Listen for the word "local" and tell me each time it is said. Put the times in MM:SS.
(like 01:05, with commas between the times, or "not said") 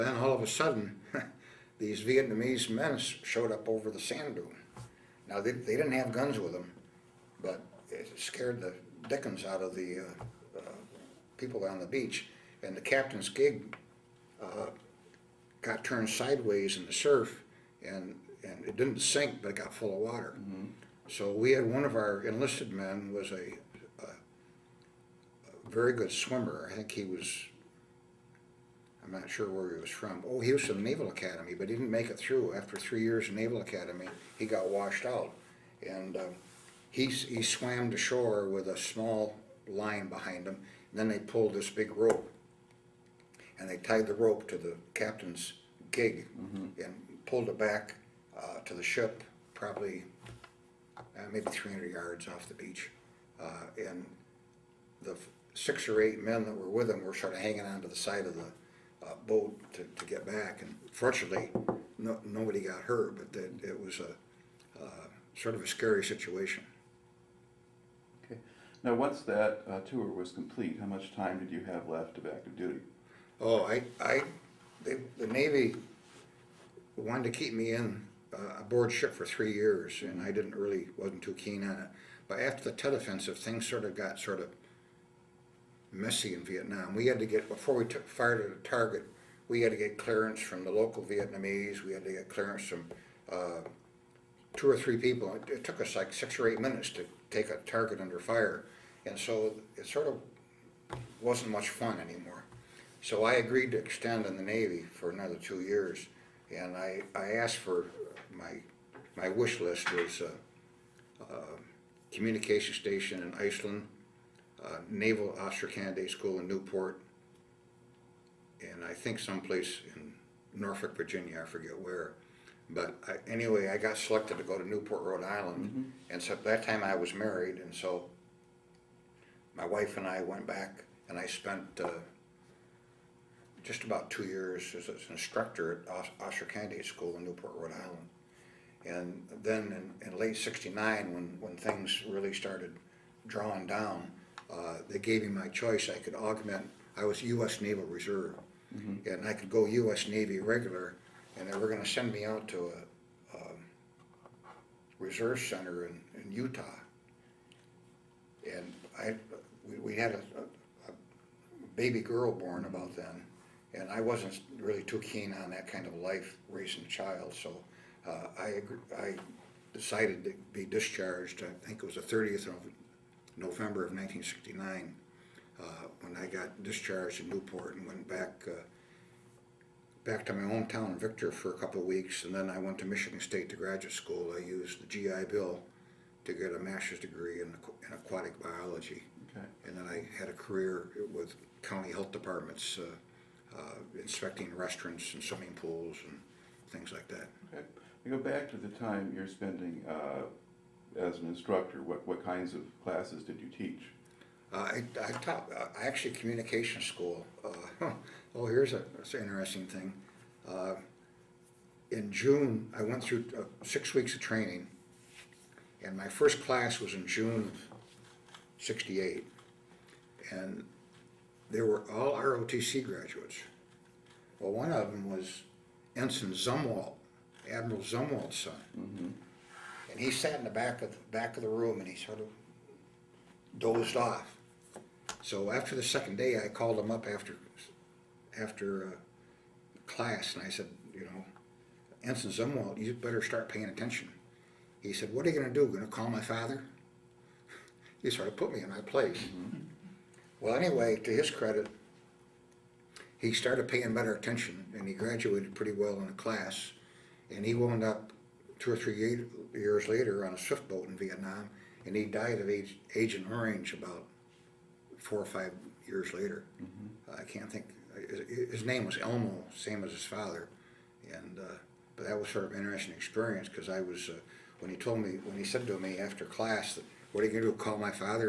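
01:30.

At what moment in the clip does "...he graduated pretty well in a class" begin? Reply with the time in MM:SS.
04:14.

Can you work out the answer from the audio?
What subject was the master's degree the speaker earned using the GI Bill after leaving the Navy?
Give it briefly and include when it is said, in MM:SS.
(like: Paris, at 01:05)
aquatic biology, at 03:07.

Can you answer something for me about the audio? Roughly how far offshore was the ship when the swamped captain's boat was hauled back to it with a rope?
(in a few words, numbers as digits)
300 yards.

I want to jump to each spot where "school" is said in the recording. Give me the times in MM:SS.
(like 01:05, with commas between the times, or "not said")
01:56, 02:16, 03:03, 03:26.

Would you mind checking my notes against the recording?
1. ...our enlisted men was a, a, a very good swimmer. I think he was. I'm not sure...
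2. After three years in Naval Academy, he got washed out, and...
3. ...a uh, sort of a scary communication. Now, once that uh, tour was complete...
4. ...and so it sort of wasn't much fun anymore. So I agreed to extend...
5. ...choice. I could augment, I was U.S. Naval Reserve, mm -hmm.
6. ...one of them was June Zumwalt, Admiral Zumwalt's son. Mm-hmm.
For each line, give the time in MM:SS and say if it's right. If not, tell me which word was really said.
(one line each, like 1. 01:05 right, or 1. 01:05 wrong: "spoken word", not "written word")
1. 00:21 right
2. 00:32 right
3. 01:03 wrong: "situation", not "communication"
4. 01:39 right
5. 02:25 right
6. 03:44 wrong: "Ensign", not "June".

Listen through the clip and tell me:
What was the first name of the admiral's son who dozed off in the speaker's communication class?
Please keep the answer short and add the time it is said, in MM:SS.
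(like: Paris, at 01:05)
Elmo, at 04:28.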